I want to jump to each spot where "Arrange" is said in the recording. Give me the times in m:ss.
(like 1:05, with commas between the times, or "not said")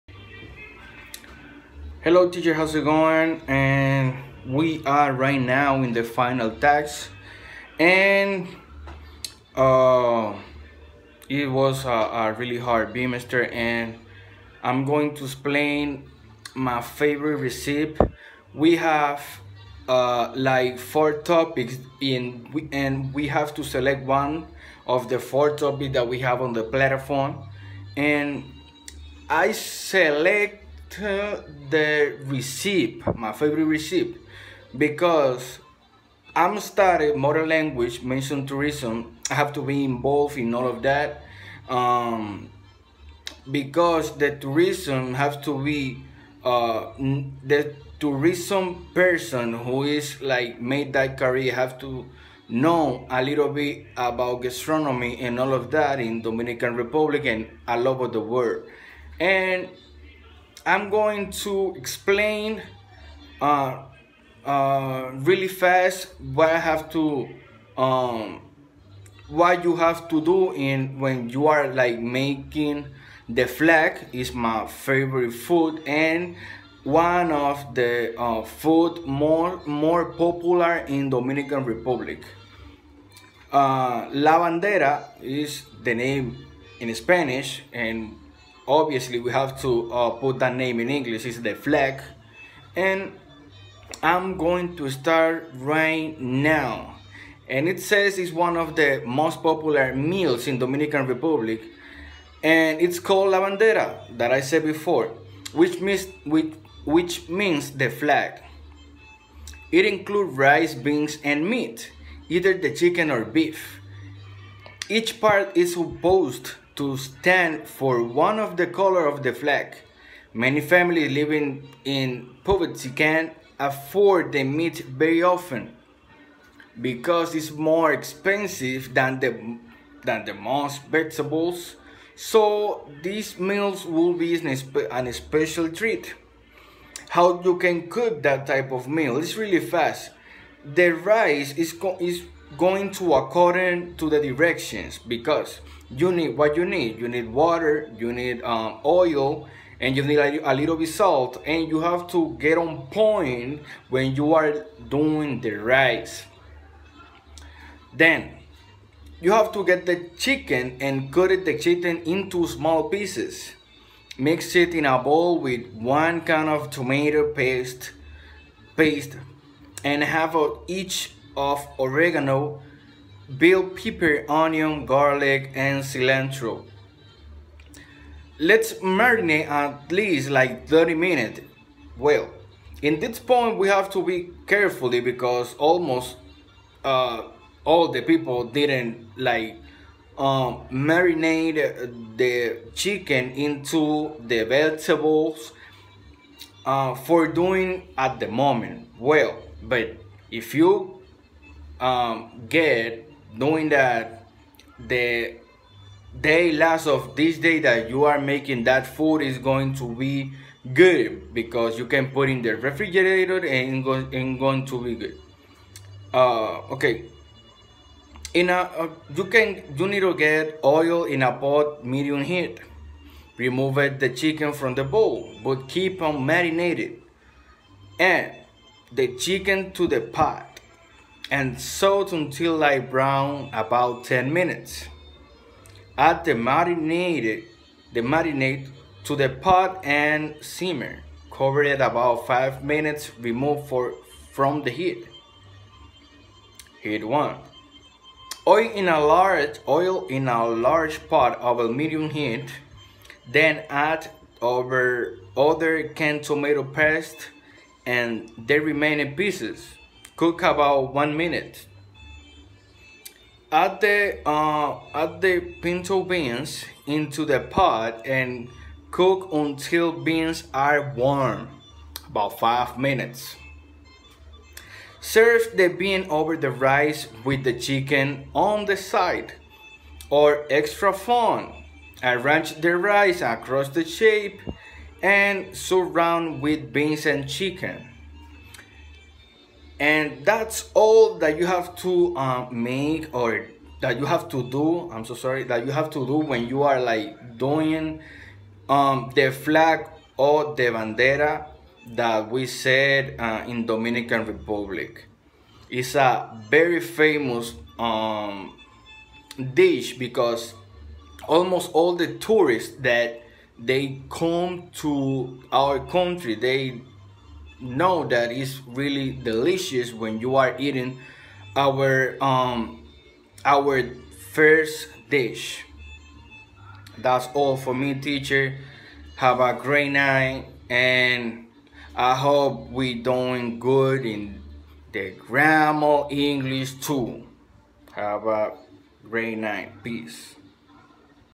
4:42.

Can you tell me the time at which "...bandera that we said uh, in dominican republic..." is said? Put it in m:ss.
5:00.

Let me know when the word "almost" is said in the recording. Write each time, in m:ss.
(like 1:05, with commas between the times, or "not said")
3:05, 5:11.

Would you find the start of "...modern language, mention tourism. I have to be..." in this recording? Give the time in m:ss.
0:37.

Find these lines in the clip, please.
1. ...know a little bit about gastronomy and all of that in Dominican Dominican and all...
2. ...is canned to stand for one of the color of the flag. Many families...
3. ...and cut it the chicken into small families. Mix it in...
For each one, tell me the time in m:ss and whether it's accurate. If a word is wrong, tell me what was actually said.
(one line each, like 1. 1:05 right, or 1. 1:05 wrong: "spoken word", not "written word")
1. 0:52 wrong: "Republic", not "Dominican"
2. 1:55 wrong: "supposed", not "canned"
3. 2:40 wrong: "pieces", not "families".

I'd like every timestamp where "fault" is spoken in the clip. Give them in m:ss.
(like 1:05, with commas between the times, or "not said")
not said.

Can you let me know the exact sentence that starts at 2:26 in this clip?
You need water, you need um, oil, and you need a, a little bit salt.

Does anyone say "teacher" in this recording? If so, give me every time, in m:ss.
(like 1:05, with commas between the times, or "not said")
0:02, 5:27.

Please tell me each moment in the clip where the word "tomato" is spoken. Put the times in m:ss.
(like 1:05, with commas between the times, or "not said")
2:46, 4:16.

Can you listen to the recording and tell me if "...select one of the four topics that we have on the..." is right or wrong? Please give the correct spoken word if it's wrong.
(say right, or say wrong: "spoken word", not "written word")
right.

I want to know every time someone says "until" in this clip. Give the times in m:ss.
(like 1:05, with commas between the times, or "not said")
3:52, 4:29.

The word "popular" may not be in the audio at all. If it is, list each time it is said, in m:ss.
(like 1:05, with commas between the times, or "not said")
1:20, 1:39.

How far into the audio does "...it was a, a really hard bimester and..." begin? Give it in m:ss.
0:11.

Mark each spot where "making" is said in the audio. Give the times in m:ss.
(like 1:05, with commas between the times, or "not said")
1:11, 3:28.